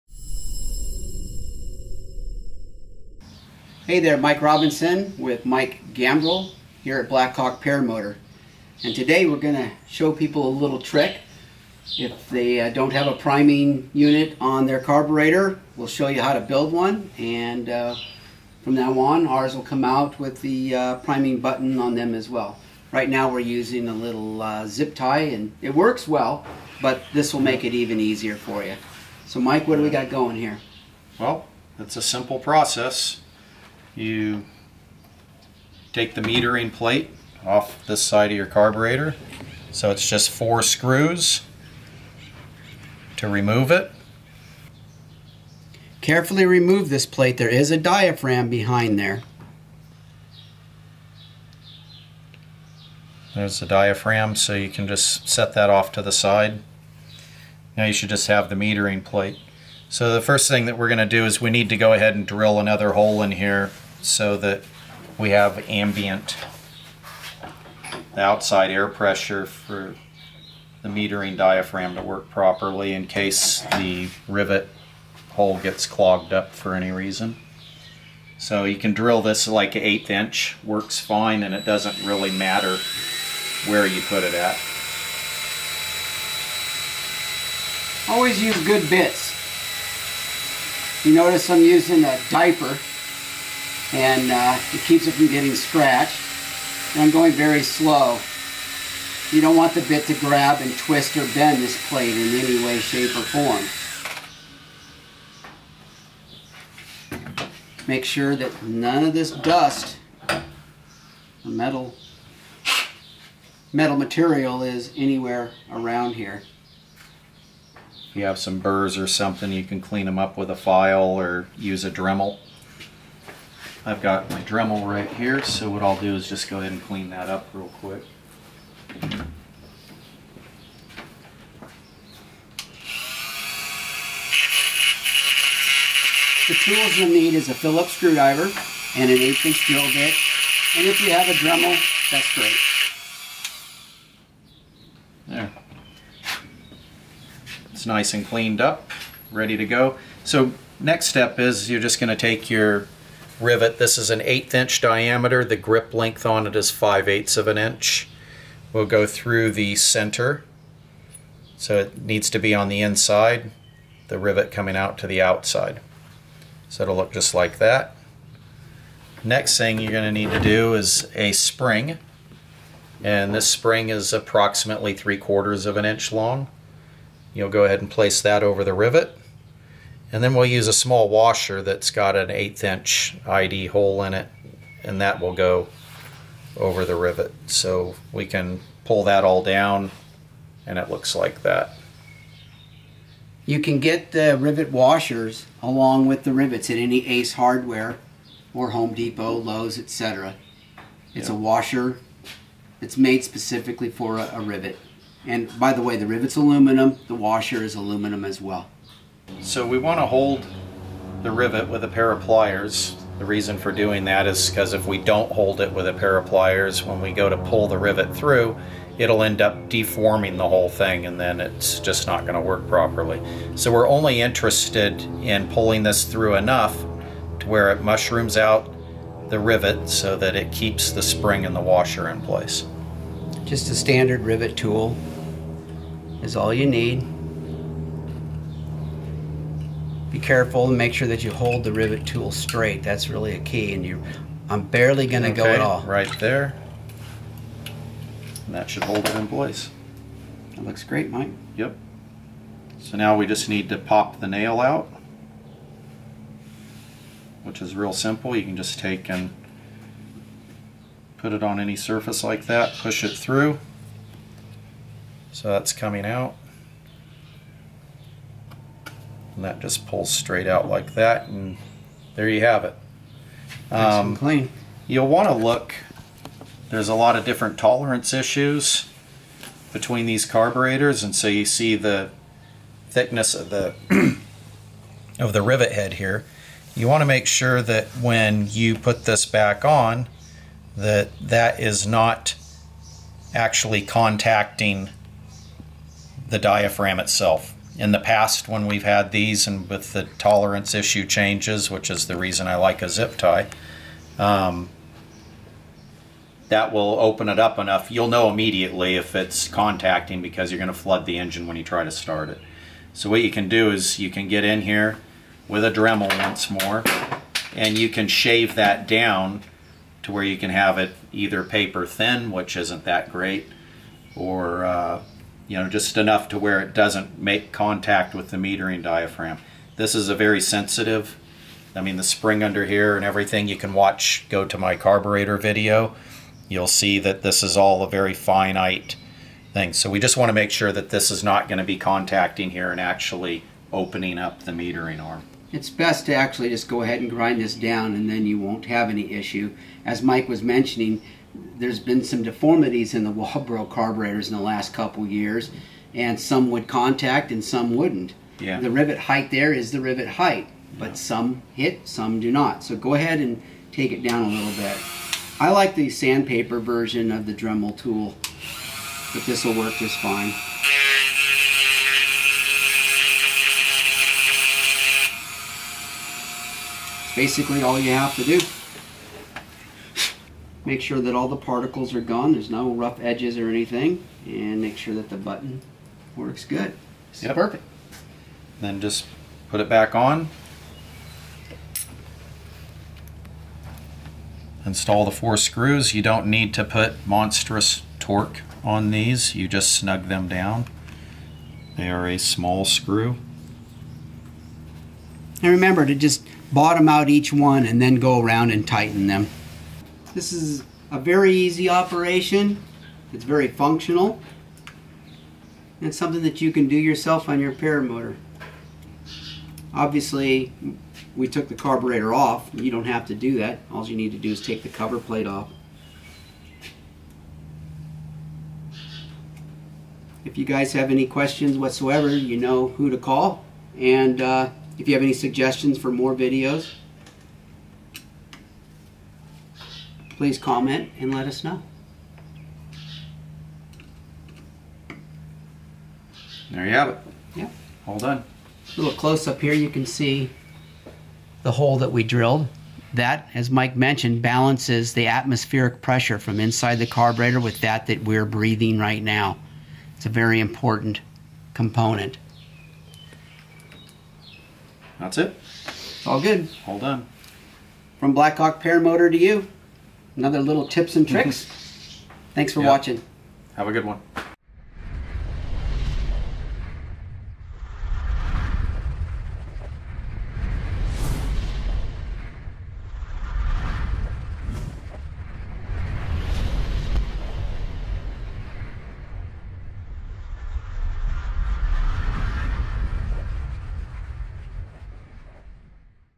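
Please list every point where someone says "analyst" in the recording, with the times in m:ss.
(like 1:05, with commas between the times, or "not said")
not said.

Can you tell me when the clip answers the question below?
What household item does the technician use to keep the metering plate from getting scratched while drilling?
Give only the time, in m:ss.
1:32.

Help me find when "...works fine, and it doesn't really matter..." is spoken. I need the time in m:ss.
1:20.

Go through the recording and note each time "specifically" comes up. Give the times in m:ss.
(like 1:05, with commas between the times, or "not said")
3:23.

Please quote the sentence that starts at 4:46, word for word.
You want to make sure that when you put this back on, that that is not actually contacting the diaphragm itself.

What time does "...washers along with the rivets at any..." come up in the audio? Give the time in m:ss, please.
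3:14.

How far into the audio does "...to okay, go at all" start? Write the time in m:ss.
4:05.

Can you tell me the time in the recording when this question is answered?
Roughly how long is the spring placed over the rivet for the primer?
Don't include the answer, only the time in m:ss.
2:54.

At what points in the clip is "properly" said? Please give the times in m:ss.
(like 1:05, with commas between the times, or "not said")
1:12, 3:42.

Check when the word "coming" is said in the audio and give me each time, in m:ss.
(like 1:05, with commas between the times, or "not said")
2:44, 4:25.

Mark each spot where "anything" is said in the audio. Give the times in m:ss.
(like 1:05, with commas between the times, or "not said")
6:23.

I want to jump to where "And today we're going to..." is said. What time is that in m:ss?
0:08.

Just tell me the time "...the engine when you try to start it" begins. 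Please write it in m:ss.
5:11.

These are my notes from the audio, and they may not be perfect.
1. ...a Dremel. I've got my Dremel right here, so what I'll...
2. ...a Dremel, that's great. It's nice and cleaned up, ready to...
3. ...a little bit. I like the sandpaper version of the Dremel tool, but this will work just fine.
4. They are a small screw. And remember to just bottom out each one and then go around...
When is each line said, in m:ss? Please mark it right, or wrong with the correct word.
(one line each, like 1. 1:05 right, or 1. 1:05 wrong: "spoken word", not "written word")
1. 2:01 right
2. 2:21 right
3. 6:04 right
4. 6:41 right.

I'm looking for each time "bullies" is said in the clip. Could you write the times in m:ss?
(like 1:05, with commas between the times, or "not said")
not said.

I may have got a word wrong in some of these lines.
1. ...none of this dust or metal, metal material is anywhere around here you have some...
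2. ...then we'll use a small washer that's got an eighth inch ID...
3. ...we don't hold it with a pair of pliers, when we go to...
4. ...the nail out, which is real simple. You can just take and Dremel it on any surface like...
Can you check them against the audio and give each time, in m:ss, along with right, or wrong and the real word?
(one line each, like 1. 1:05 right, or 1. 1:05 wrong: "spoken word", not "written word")
1. 1:48 right
2. 3:00 right
3. 3:34 right
4. 4:14 wrong: "Put", not "Dremel".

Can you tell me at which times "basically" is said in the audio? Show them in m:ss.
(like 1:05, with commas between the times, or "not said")
6:17.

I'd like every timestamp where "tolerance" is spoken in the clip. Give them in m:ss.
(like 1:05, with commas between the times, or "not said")
4:37, 5:00.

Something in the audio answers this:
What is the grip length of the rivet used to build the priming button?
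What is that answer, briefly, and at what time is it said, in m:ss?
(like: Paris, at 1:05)
5/8 inch, at 2:36.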